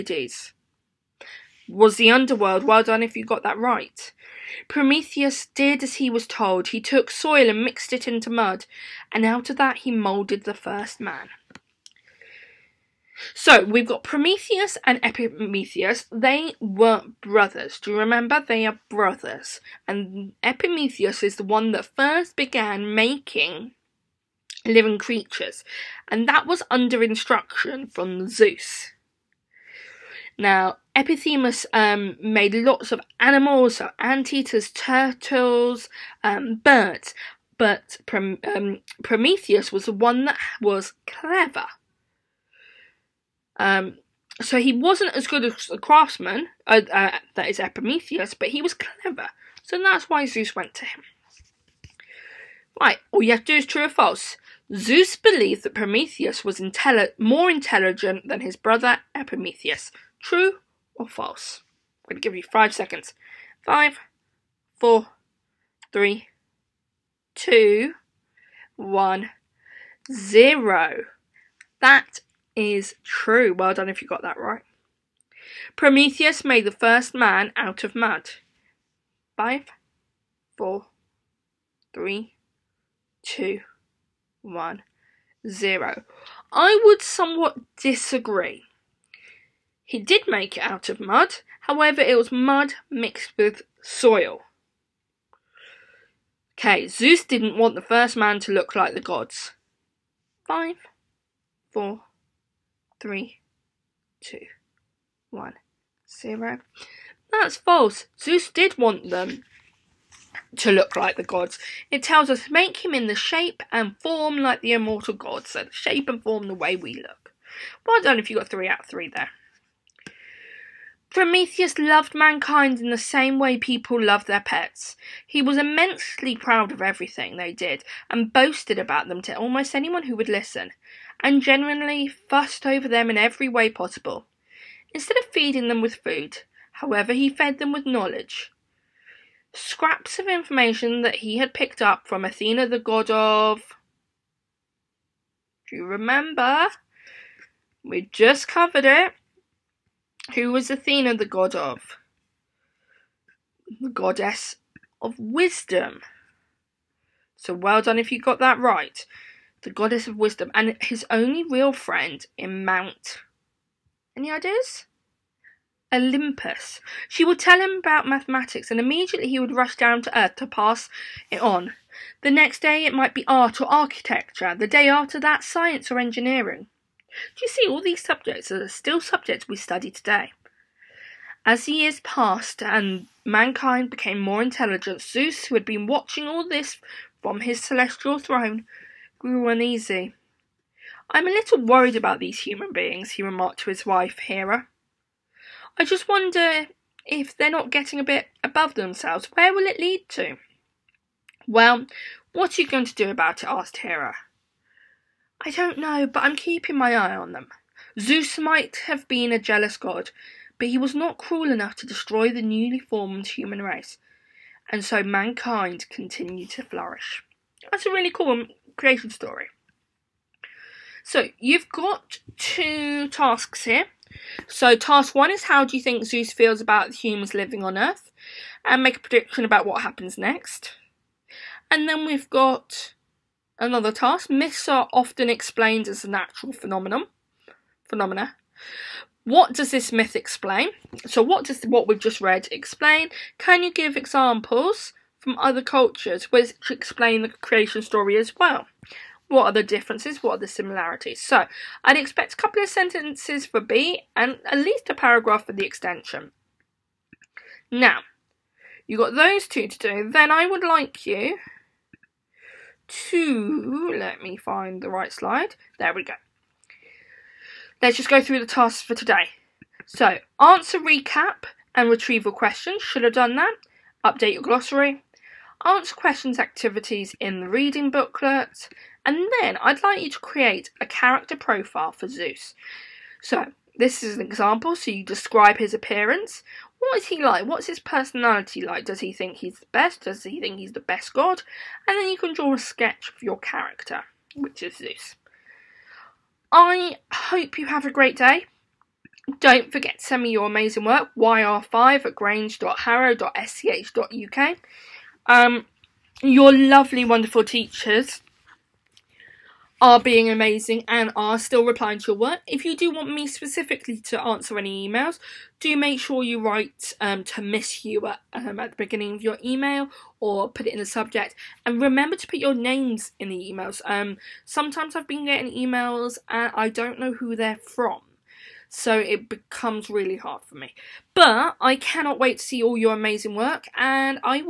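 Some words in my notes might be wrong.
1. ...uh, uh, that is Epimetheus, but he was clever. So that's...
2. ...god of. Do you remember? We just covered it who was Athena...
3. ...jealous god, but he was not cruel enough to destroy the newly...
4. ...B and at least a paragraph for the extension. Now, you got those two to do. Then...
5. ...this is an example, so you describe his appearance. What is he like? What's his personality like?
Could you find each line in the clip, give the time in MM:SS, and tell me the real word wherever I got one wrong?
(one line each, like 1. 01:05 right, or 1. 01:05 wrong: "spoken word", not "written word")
1. 00:46 right
2. 02:22 right
3. 03:29 right
4. 04:13 right
5. 04:43 right.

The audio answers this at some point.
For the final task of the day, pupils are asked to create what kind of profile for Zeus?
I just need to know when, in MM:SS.
04:40.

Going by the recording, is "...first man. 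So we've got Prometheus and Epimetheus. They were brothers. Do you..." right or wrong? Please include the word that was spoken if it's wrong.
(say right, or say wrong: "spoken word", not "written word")
right.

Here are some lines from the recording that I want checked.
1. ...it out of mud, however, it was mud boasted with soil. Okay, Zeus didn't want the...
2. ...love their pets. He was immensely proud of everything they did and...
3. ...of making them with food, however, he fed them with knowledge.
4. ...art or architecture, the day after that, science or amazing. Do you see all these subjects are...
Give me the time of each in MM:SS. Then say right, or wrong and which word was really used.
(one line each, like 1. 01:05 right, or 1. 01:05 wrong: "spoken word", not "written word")
1. 01:30 wrong: "mixed", not "boasted"
2. 02:03 right
3. 02:15 wrong: "feeding", not "making"
4. 02:53 wrong: "engineering", not "amazing".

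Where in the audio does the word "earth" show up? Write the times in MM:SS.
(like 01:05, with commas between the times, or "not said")
02:50, 03:47.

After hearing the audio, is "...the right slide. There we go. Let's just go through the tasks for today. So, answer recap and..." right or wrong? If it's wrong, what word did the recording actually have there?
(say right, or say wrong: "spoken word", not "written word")
right.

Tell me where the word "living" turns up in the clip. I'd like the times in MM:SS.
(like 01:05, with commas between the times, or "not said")
00:24, 03:47.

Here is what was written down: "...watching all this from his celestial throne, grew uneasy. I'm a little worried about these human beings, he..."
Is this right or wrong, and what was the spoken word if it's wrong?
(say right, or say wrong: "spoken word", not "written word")
right.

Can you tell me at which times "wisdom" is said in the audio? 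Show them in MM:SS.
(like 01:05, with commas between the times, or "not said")
02:35, 02:40.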